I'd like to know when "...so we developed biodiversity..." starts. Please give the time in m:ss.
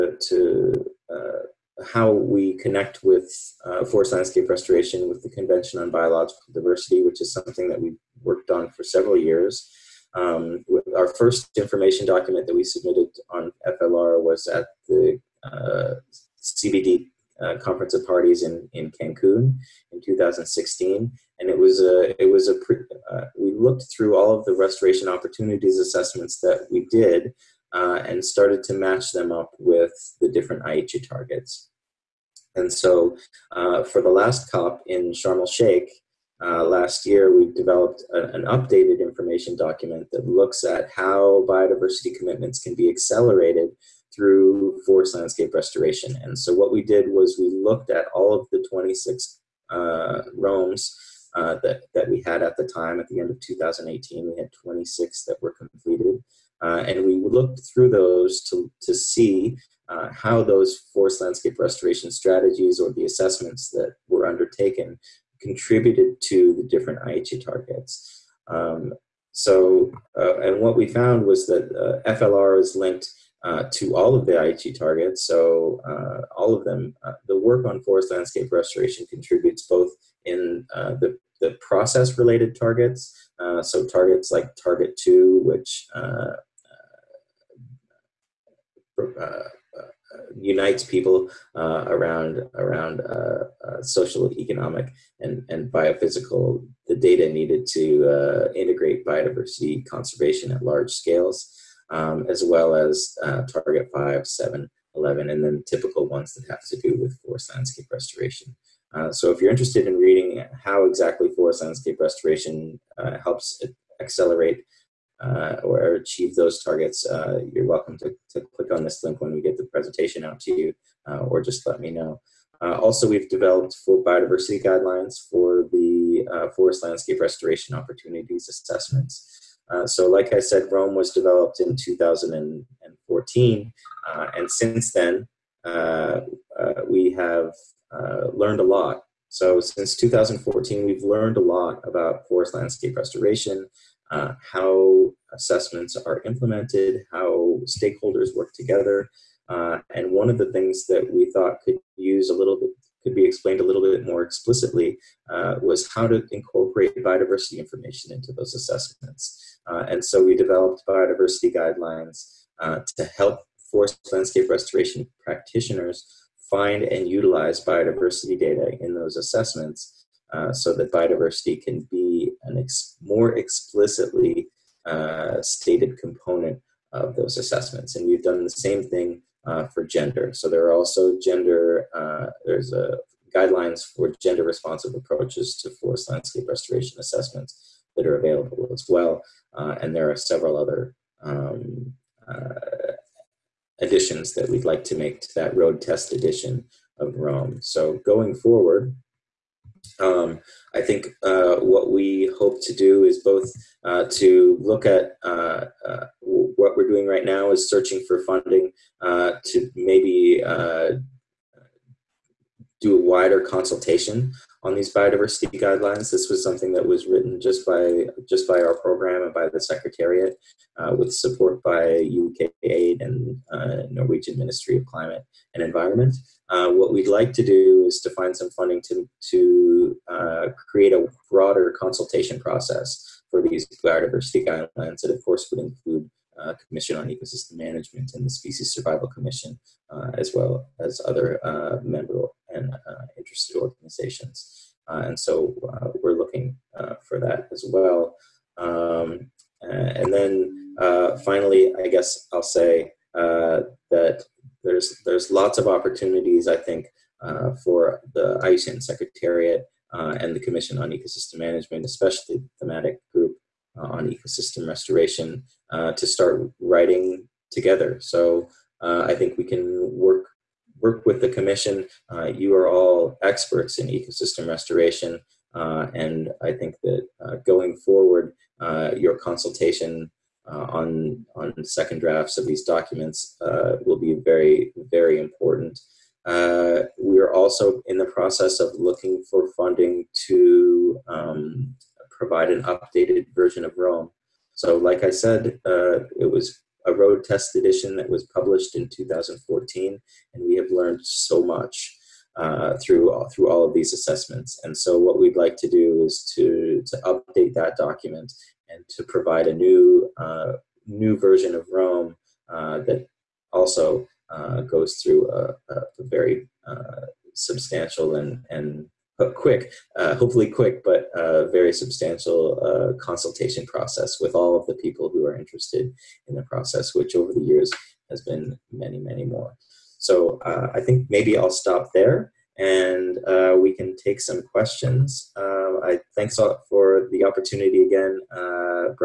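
2:40.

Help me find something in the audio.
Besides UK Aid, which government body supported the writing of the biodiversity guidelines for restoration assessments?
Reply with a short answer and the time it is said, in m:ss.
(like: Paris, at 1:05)
Norwegian Ministry of Climate and Environment, at 3:43.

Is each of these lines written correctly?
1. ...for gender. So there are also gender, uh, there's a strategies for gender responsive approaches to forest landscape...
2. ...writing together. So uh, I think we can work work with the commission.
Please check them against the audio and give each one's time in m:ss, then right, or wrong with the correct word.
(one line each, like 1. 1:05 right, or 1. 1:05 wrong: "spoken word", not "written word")
1. 2:59 wrong: "guidelines", not "strategies"
2. 4:26 right.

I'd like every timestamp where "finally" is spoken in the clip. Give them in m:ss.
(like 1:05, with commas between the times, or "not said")
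4:11.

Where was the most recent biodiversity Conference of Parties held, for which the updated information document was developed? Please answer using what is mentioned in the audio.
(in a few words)
Sharm el Sheikh.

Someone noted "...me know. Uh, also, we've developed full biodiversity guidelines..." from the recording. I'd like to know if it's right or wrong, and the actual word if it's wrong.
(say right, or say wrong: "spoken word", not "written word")
right.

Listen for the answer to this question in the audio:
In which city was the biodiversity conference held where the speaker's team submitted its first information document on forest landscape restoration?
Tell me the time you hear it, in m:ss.
0:18.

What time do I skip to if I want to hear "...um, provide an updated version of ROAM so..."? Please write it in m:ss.
4:51.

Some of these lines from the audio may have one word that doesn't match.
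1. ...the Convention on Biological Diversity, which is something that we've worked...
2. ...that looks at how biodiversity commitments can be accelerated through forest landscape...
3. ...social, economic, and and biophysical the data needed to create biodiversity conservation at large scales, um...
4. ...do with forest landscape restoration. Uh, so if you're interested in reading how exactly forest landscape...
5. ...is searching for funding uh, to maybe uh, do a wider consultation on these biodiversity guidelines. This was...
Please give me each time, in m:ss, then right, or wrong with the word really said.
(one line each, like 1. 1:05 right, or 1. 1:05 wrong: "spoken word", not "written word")
1. 0:05 right
2. 0:40 right
3. 1:33 wrong: "integrate", not "create"
4. 1:46 right
5. 3:27 right.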